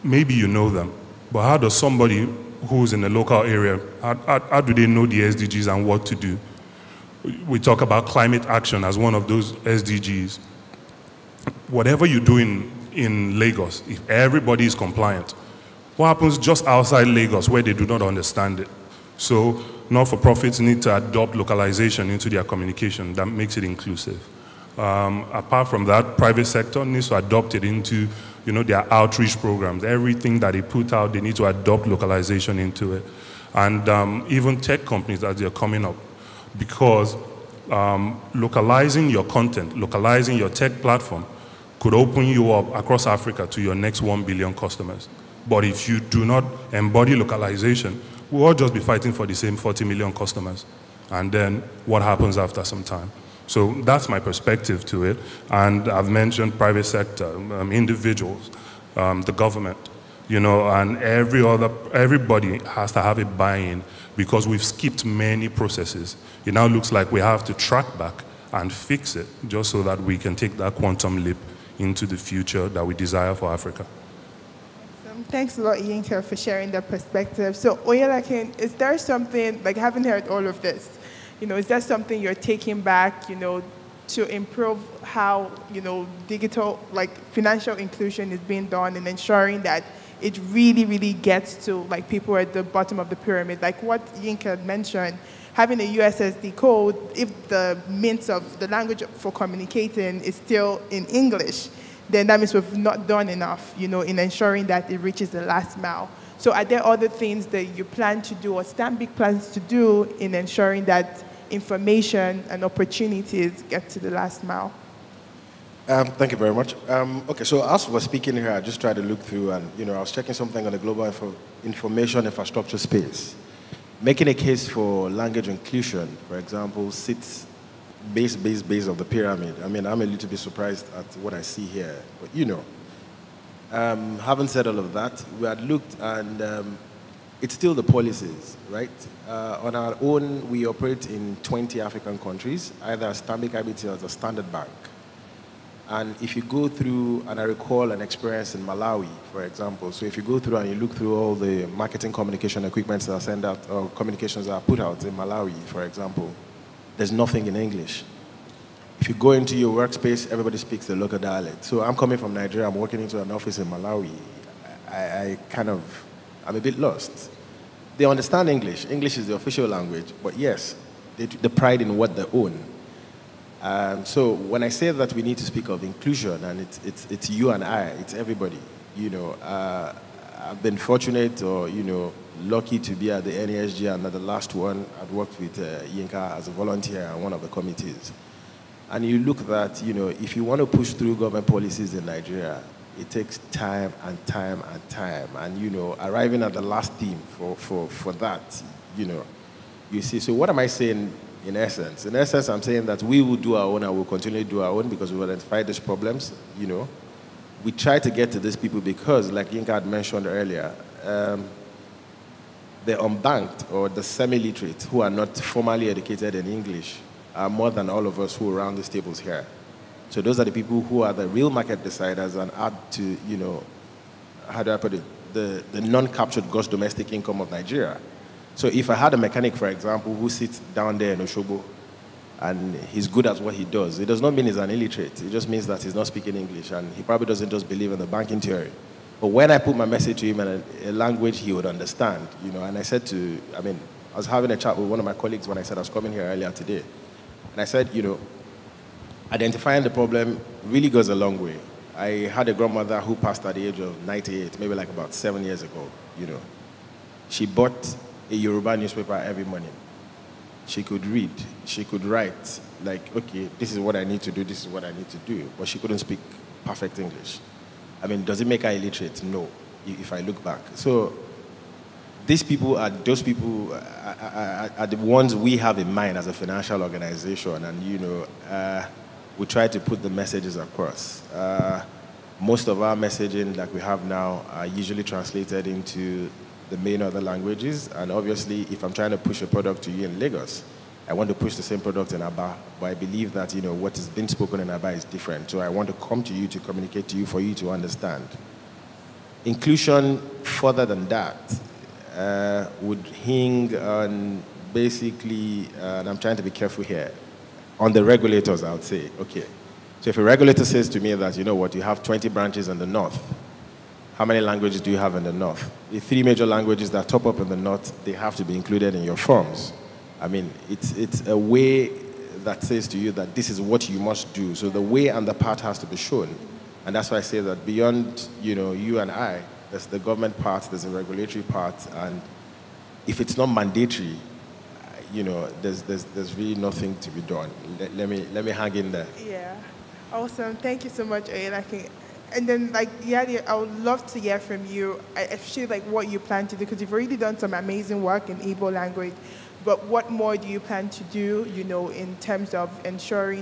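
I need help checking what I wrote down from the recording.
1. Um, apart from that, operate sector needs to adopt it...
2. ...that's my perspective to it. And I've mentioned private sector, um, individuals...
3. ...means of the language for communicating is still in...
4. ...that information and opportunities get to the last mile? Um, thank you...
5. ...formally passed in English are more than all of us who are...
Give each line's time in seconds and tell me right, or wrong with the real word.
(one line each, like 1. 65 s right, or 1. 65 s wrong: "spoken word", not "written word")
1. 24 s wrong: "private", not "operate"
2. 53 s right
3. 97 s right
4. 110 s right
5. 215 s wrong: "educated", not "passed".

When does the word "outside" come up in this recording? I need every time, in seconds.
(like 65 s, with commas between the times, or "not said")
16 s.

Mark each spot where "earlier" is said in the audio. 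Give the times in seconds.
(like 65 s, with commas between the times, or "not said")
210 s, 246 s.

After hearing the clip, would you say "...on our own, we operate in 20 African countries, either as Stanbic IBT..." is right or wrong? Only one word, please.
right.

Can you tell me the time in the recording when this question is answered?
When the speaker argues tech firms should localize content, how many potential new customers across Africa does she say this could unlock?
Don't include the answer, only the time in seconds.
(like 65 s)
44 s.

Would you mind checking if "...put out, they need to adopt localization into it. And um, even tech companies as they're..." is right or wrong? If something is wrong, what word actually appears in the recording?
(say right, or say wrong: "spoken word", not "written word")
right.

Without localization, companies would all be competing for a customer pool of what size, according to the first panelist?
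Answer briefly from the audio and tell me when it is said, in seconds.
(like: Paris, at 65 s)
40 million, at 49 s.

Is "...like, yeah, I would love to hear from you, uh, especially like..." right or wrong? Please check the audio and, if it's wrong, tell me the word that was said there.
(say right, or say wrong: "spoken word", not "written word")
right.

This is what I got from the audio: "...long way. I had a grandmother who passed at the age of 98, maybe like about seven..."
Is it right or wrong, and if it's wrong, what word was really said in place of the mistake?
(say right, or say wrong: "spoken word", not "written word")
right.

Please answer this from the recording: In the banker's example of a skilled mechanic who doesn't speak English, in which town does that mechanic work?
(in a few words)
Oshobo.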